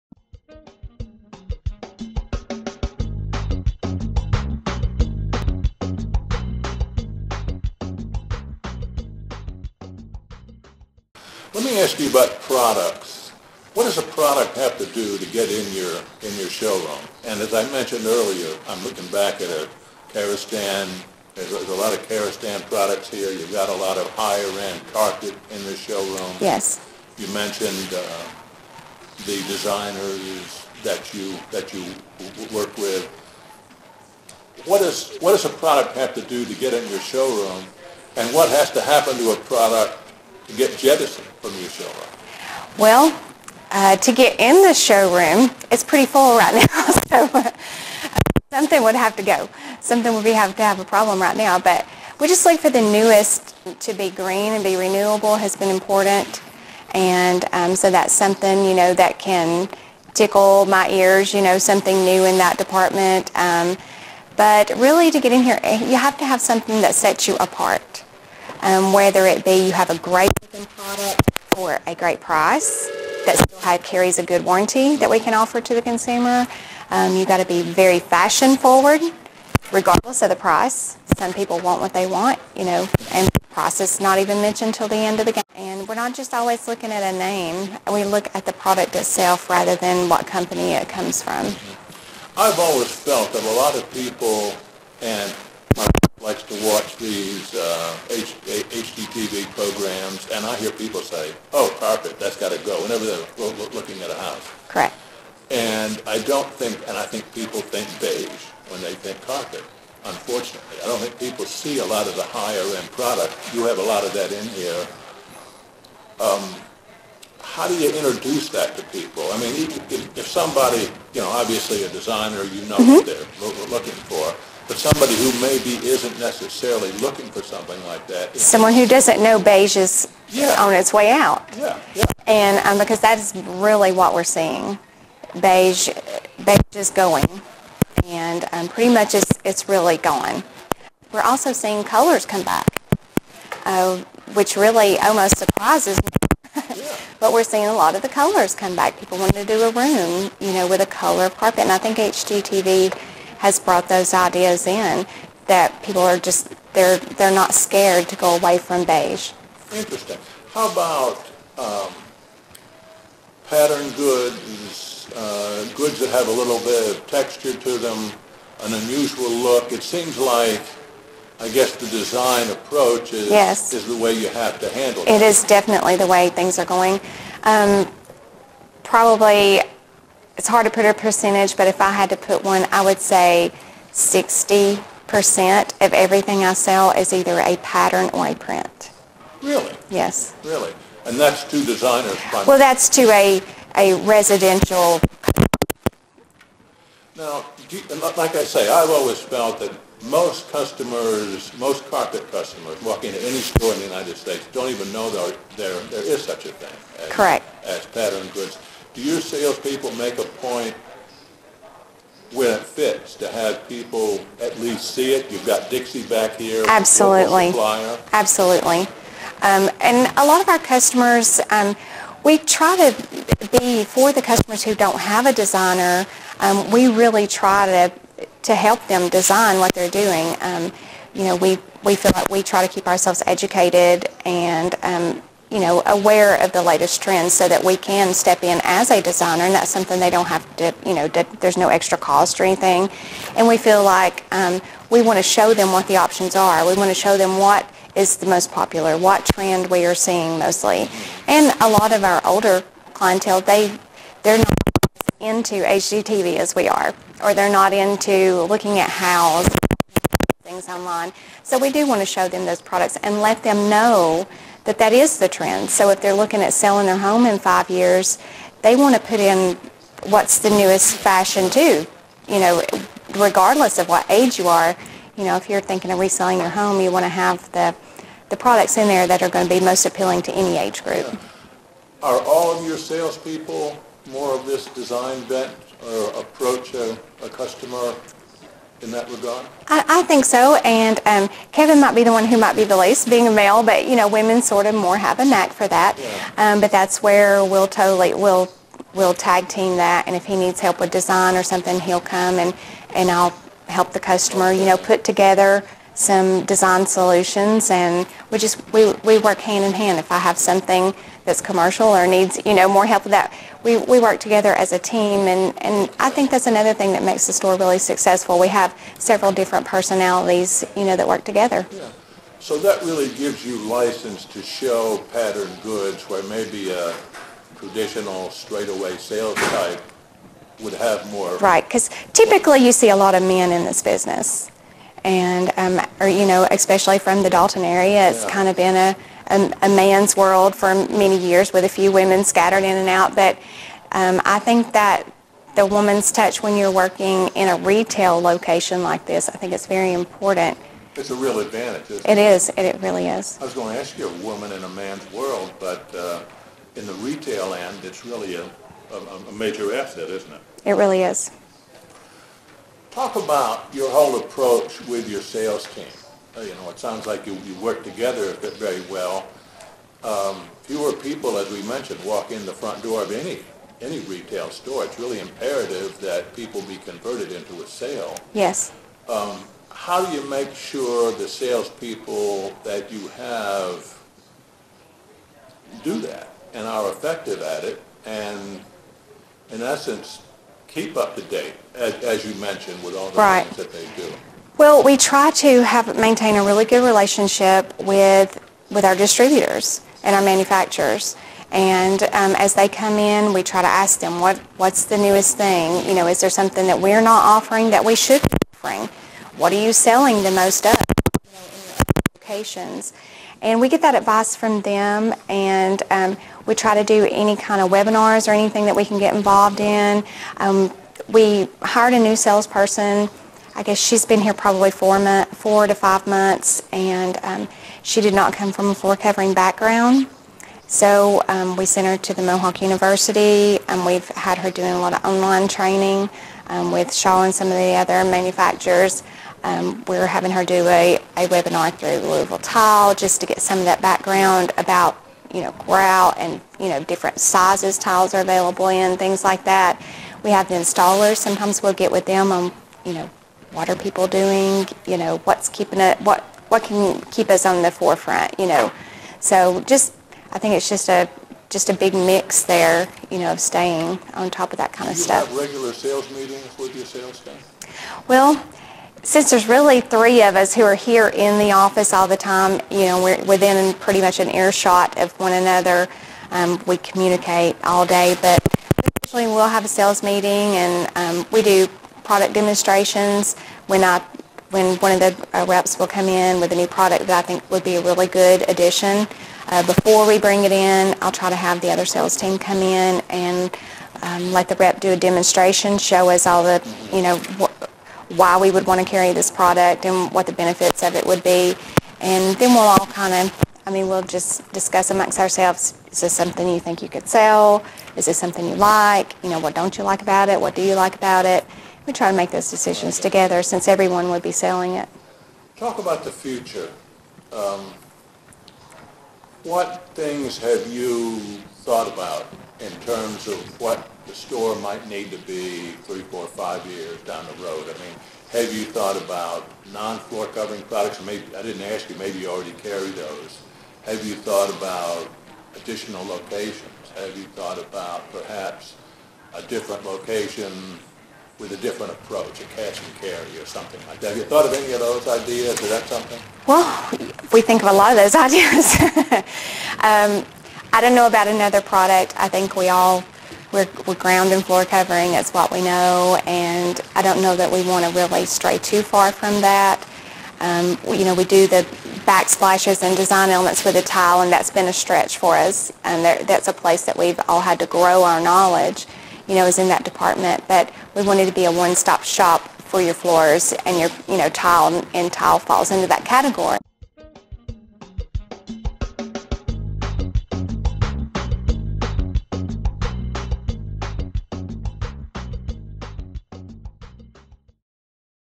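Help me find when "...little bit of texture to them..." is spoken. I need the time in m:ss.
2:46.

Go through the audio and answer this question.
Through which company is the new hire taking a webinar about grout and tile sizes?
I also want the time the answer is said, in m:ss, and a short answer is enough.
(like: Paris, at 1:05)
Louisville Tile, at 7:22.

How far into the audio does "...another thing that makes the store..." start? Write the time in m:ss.
5:16.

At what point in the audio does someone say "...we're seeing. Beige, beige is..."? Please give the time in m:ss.
2:14.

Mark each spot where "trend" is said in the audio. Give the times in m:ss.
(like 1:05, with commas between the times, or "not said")
3:57, 4:09, 4:25.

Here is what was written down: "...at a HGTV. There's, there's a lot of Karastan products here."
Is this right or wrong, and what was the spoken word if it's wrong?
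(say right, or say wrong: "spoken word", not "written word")
wrong: "Karastan", not "HGTV".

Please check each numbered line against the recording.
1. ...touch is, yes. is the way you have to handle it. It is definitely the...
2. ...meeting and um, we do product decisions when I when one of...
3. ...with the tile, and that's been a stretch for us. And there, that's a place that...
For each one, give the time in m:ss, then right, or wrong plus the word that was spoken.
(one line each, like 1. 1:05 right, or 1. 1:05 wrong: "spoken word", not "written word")
1. 2:52 wrong: "approach", not "touch"
2. 8:00 wrong: "demonstrations", not "decisions"
3. 9:23 right.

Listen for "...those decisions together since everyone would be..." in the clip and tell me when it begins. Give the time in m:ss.
8:32.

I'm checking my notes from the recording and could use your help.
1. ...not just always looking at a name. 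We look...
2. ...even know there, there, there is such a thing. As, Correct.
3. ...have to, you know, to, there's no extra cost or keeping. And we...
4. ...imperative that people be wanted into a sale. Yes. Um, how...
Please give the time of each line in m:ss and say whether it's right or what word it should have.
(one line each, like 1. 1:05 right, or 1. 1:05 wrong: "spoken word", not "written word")
1. 1:25 right
2. 3:24 right
3. 4:00 wrong: "anything", not "keeping"
4. 6:15 wrong: "converted", not "wanted".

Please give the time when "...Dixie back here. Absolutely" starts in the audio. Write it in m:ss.
3:35.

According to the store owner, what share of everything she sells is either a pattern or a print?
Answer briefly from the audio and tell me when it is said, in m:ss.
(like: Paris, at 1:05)
60%, at 3:03.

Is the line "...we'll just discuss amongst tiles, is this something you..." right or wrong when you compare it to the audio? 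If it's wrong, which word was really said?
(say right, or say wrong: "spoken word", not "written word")
wrong: "ourselves", not "tiles".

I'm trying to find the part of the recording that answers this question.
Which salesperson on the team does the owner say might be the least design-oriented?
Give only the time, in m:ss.
4:51.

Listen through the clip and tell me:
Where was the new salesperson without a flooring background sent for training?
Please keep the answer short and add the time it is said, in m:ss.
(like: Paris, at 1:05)
Mohawk University, at 7:12.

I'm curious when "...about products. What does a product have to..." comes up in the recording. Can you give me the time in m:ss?
0:12.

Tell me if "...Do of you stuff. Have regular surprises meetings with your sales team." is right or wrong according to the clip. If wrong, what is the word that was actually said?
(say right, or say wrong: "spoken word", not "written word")
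wrong: "sales", not "surprises".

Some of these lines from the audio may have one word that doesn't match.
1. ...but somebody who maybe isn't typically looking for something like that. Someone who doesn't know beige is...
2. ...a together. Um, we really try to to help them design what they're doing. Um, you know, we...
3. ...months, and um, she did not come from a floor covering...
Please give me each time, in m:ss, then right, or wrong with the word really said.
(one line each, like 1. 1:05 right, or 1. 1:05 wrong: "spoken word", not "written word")
1. 2:04 wrong: "necessarily", not "typically"
2. 3:45 wrong: "designer", not "together"
3. 7:06 right.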